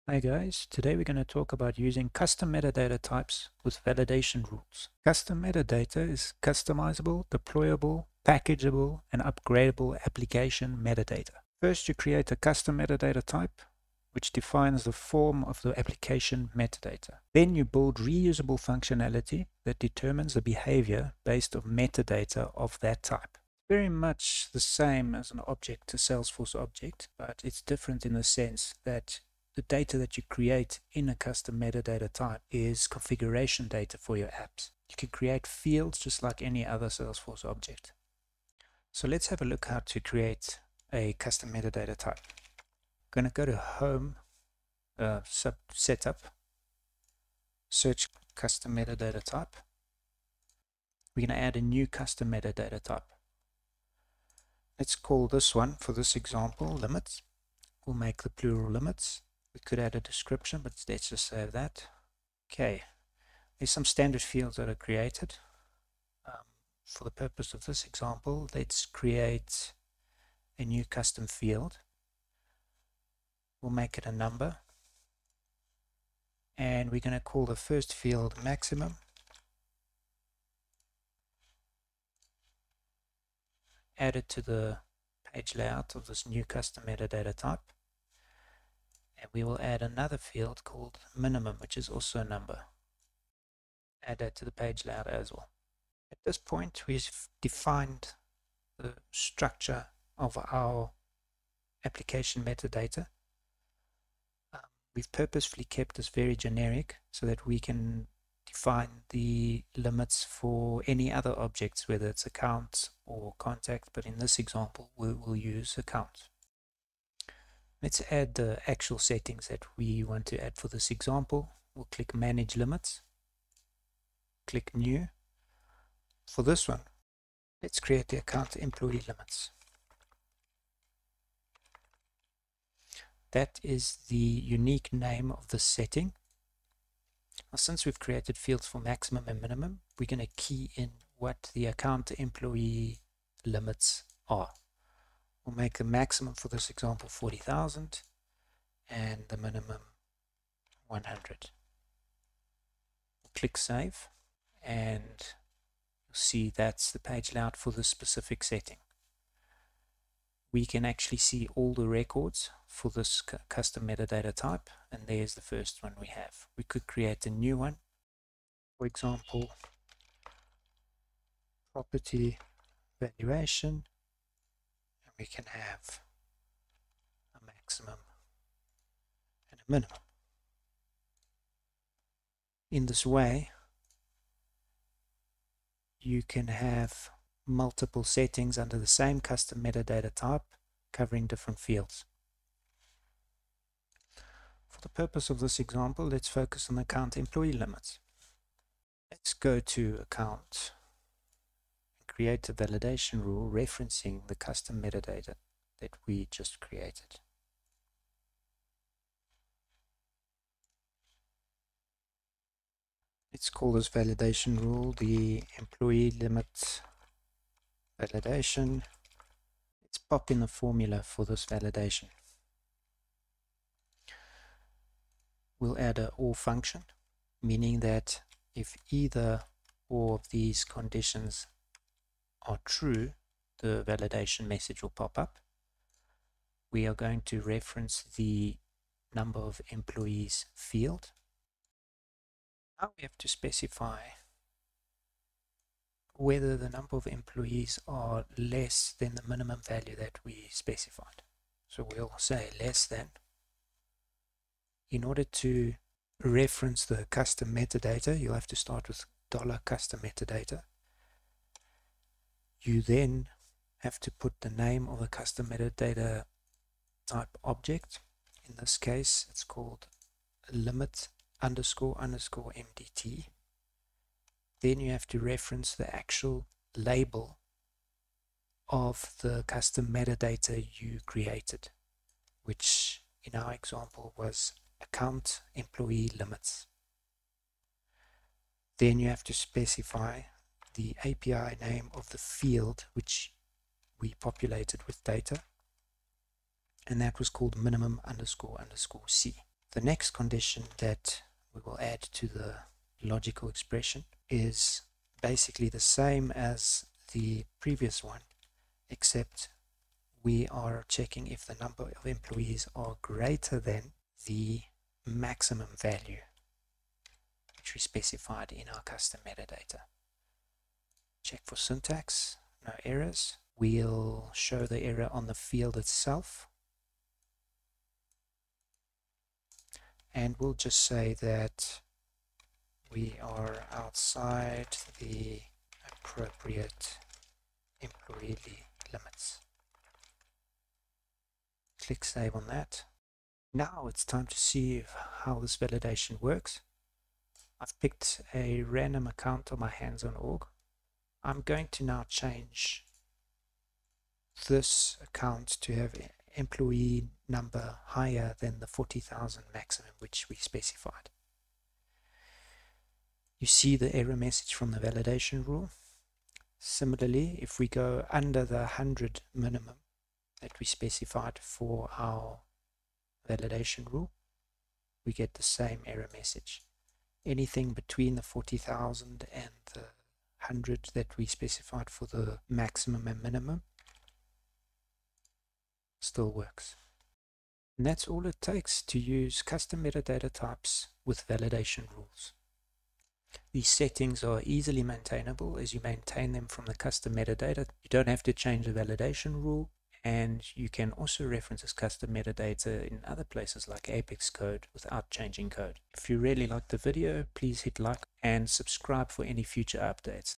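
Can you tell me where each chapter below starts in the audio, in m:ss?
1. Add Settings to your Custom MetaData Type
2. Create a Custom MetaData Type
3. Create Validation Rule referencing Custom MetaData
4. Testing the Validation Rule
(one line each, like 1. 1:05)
1. 1:57
2. 0:38
3. 3:18
4. 5:43.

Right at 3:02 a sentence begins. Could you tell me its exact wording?
In this way, you can have multiple settings under the same custom metadata type covering different fields.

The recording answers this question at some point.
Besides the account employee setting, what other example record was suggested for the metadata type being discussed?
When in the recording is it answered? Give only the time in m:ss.
2:51.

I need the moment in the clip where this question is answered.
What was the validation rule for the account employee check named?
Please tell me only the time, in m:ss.
3:35.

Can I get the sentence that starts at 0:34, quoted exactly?
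You can create fields just like any other Salesforce object.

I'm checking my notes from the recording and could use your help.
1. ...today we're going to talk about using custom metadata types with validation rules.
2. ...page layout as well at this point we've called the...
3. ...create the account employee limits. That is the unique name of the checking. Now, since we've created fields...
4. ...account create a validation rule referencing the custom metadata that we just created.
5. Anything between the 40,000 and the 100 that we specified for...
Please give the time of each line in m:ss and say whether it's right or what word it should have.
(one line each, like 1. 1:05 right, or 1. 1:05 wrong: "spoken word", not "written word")
1. 0:00 right
2. 1:34 wrong: "defined", not "called"
3. 2:07 wrong: "setting", not "checking"
4. 3:20 right
5. 6:17 right.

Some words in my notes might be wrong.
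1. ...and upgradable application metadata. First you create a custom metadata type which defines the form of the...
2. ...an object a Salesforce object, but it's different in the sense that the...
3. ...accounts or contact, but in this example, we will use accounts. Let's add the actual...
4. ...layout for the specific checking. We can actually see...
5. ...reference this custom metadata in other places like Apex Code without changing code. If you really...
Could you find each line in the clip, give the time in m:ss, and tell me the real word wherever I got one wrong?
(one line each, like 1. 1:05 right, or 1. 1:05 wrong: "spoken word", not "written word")
1. 0:09 right
2. 0:25 right
3. 1:52 right
4. 2:37 wrong: "setting", not "checking"
5. 6:41 right.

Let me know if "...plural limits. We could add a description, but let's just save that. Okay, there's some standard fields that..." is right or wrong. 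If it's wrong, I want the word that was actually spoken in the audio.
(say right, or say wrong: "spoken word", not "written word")
right.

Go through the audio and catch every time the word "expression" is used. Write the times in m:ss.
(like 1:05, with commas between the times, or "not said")
5:03.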